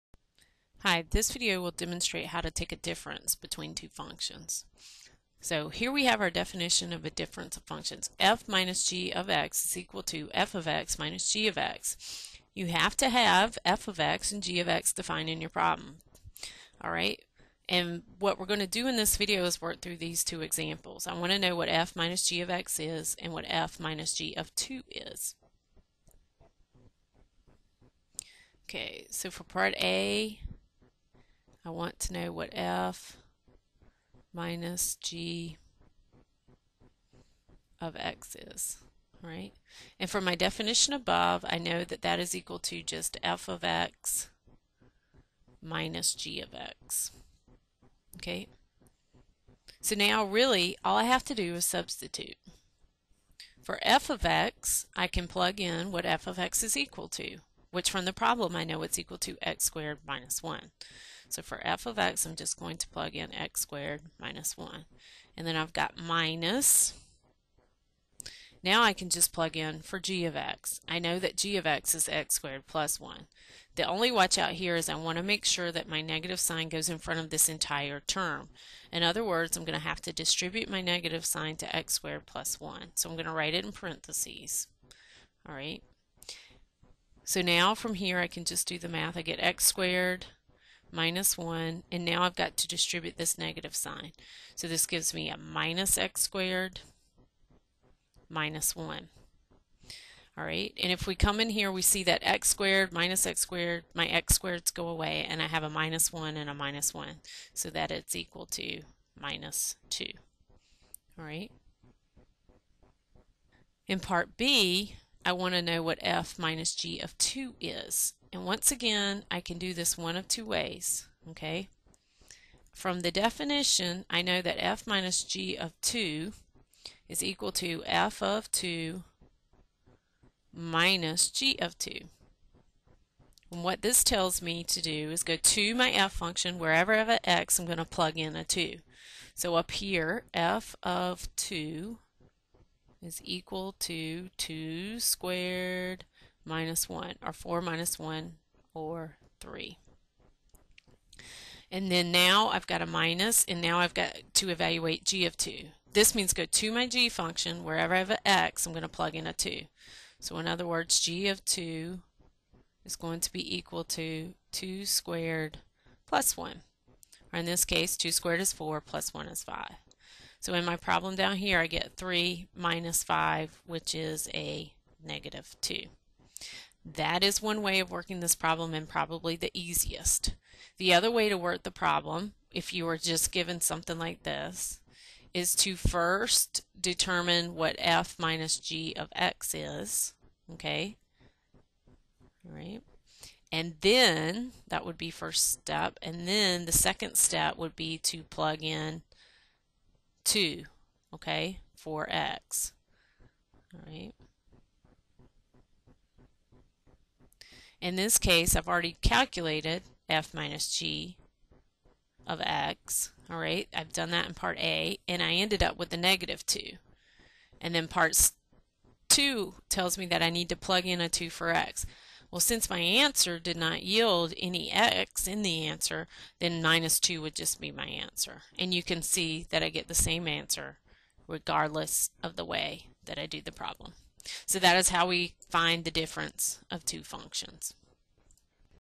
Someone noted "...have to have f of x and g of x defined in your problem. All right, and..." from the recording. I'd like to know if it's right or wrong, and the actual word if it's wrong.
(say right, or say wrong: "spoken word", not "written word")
right.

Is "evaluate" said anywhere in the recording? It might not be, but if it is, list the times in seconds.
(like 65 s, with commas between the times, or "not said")
154 s.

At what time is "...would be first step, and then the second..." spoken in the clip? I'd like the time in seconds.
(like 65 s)
194 s.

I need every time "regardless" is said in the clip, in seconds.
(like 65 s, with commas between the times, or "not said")
231 s.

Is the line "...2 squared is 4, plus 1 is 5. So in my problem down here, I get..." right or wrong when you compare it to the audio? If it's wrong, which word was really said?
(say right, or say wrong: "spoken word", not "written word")
right.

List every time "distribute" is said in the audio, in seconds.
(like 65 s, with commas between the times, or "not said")
80 s, 92 s.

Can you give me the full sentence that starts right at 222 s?
Well, since my answer did not yield any x in the answer, then minus 2 would just be my answer.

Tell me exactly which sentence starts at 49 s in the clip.
So now really all I have to do is substitute.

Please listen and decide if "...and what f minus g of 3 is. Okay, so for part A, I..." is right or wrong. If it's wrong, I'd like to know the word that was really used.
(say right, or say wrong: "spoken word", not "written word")
wrong: "2", not "3".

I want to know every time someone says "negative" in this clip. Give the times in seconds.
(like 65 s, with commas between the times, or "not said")
76 s, 80 s, 93 s, 175 s, 215 s.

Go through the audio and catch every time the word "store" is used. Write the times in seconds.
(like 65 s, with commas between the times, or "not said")
not said.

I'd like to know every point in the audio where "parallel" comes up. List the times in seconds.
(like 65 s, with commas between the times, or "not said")
not said.